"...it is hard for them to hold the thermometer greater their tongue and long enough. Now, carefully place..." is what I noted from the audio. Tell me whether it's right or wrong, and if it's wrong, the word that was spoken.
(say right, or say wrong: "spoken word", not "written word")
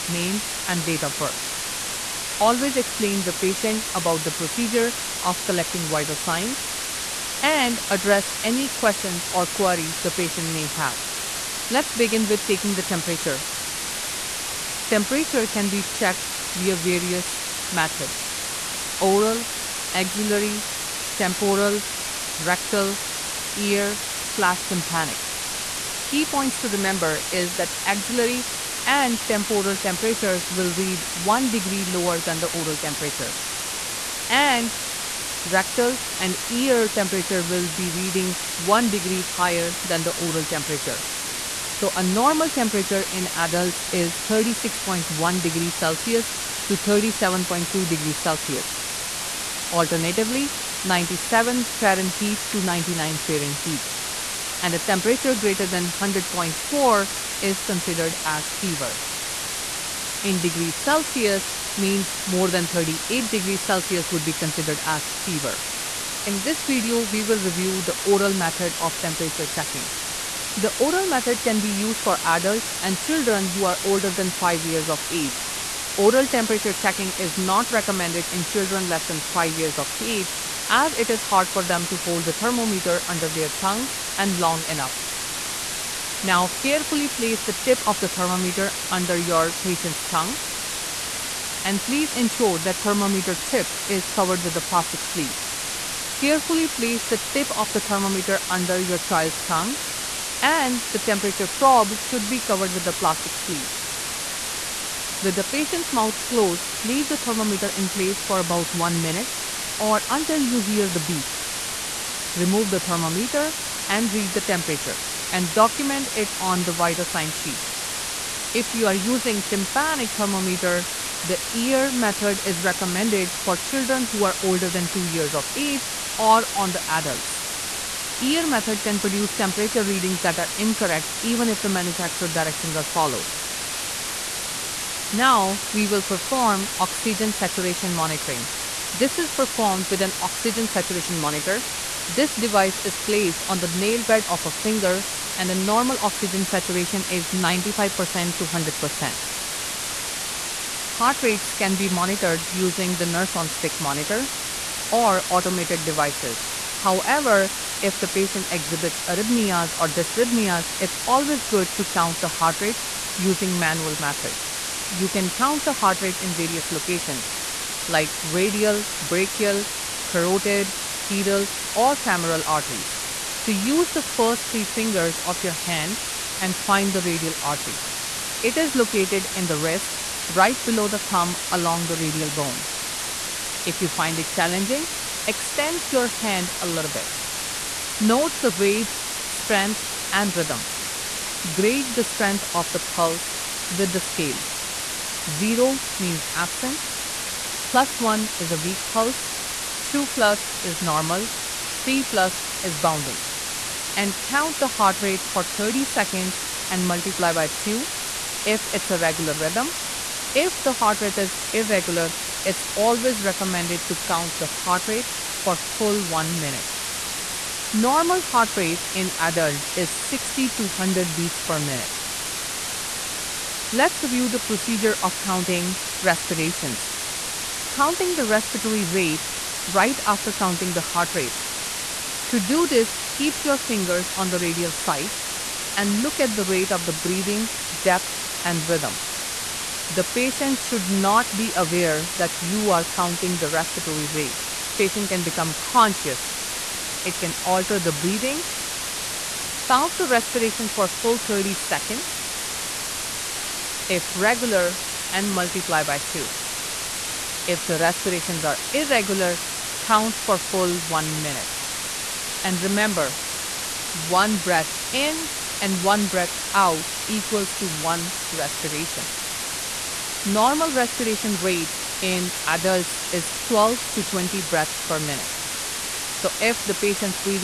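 wrong: "under", not "greater".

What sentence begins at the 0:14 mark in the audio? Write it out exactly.
Temperature can be checked via various methods oral, axillary, temporal, rectal, ear, slash tympanic.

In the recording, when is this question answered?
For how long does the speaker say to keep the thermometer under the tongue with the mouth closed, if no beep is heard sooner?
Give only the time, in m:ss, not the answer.
1:48.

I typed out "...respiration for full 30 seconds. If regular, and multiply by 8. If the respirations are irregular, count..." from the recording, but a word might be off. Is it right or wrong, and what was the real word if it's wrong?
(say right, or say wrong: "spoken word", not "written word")
wrong: "2", not "8".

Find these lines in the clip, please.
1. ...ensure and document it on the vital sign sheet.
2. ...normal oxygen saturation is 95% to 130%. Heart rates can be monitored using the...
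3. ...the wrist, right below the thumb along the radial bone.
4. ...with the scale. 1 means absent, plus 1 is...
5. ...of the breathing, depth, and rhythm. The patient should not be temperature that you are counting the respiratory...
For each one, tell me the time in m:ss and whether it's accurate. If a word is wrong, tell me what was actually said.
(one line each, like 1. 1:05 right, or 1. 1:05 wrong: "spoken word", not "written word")
1. 1:54 wrong: "temperature", not "ensure"
2. 2:25 wrong: "100", not "130"
3. 2:59 right
4. 3:13 wrong: "0", not "1"
5. 3:56 wrong: "aware", not "temperature".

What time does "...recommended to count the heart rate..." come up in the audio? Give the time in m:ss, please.
3:33.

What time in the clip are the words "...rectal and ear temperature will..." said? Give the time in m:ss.
0:35.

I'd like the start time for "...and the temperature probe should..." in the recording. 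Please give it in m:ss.
1:40.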